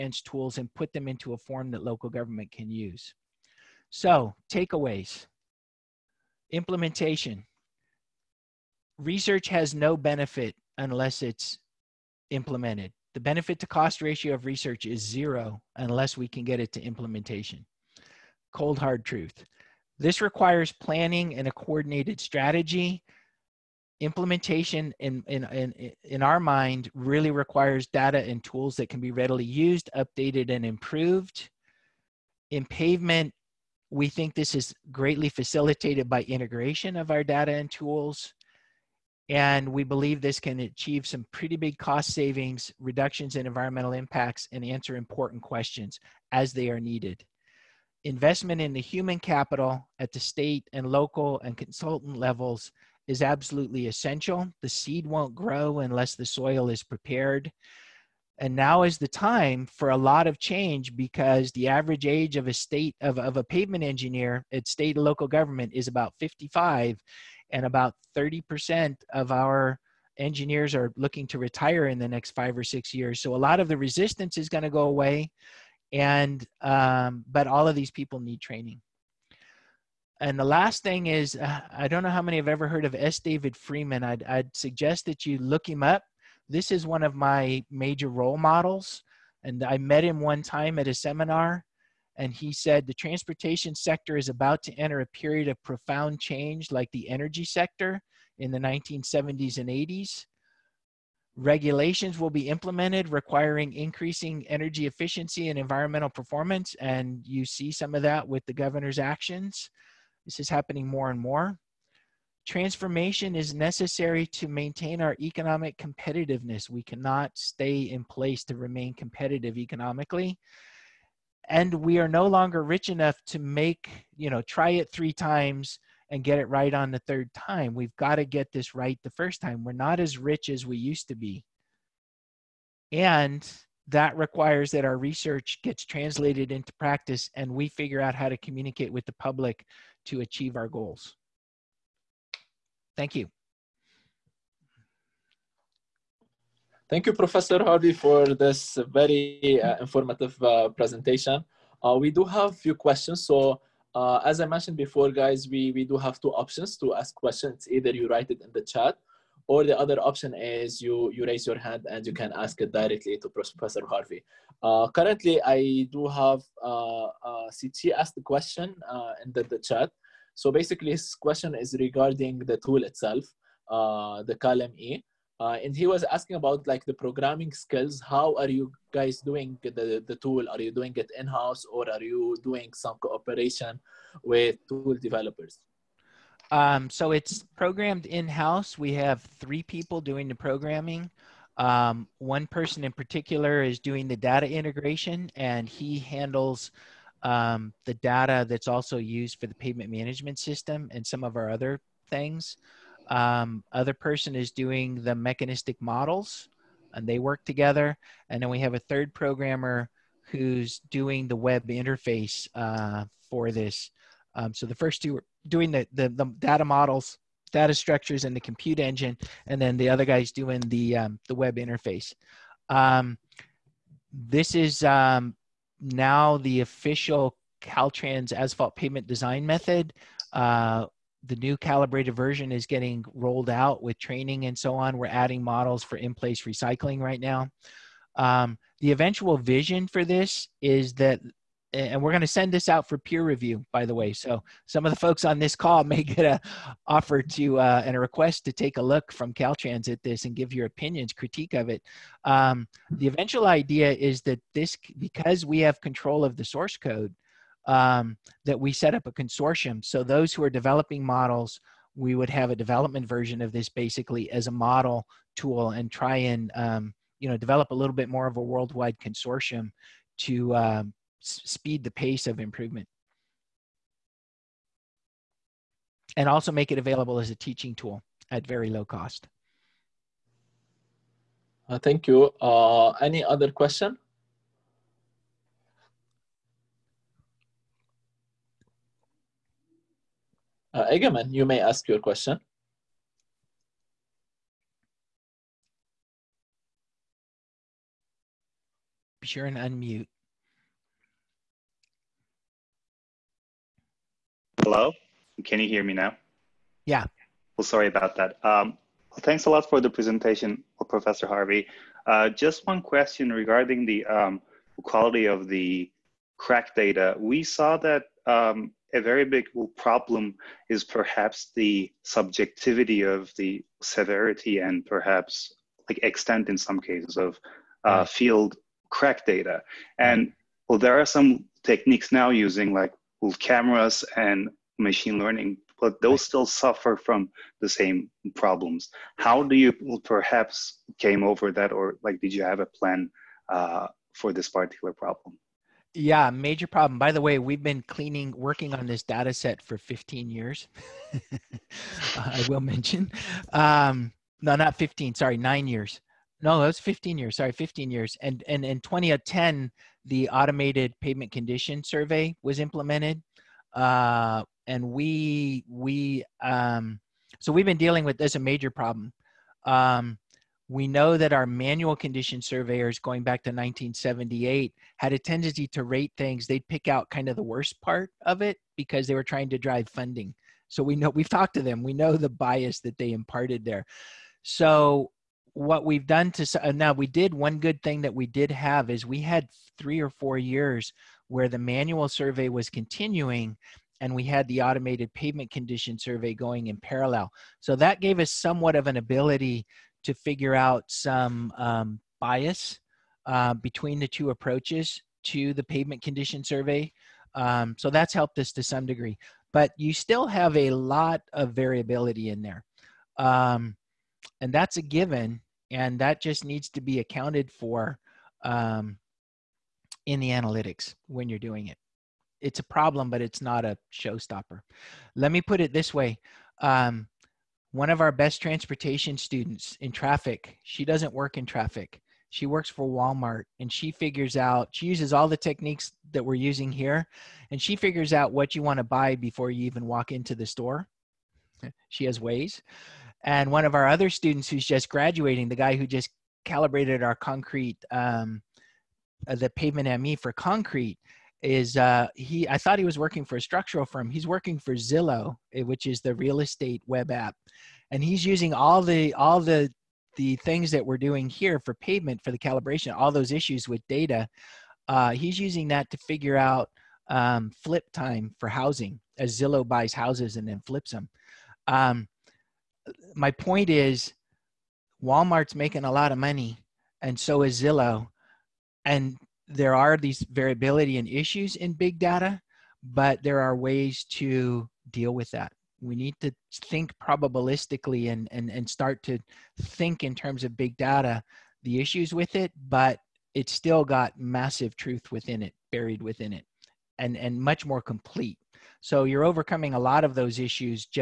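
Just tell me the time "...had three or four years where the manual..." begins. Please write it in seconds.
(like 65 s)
389 s.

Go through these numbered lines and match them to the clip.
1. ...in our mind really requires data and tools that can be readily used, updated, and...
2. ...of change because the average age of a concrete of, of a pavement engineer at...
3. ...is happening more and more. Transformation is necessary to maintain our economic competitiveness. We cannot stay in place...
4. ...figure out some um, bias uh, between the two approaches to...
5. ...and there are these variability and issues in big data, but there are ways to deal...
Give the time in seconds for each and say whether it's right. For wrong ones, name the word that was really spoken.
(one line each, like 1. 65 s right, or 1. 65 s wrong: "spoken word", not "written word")
1. 26 s right
2. 60 s wrong: "state", not "concrete"
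3. 110 s right
4. 400 s right
5. 478 s right.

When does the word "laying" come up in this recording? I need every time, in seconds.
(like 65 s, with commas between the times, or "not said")
not said.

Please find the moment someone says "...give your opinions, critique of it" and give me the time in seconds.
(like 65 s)
250 s.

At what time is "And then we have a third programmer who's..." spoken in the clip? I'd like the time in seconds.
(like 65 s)
208 s.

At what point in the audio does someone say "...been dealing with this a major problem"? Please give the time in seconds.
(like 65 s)
367 s.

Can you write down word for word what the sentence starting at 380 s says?
So we know we've talked to them.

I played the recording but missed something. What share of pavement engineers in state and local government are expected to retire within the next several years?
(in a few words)
30%.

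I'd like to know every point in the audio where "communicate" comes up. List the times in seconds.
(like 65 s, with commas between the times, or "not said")
138 s.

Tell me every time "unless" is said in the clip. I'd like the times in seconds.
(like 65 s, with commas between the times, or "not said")
10 s, 15 s, 55 s.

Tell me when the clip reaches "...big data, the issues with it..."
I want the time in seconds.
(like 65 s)
490 s.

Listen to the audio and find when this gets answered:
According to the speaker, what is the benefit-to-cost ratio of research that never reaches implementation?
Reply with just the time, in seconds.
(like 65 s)
14 s.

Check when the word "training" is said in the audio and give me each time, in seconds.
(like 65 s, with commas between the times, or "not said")
78 s, 233 s.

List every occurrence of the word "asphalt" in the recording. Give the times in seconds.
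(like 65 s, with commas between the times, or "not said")
228 s.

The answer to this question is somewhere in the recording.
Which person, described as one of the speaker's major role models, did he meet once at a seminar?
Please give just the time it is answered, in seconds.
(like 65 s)
82 s.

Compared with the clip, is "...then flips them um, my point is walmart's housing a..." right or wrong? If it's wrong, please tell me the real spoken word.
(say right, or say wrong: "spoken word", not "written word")
wrong: "making", not "housing".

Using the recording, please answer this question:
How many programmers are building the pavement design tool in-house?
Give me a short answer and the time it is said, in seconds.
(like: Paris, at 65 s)
3, at 189 s.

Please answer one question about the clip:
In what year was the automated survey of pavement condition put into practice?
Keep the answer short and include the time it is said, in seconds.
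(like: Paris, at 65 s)
2010, at 358 s.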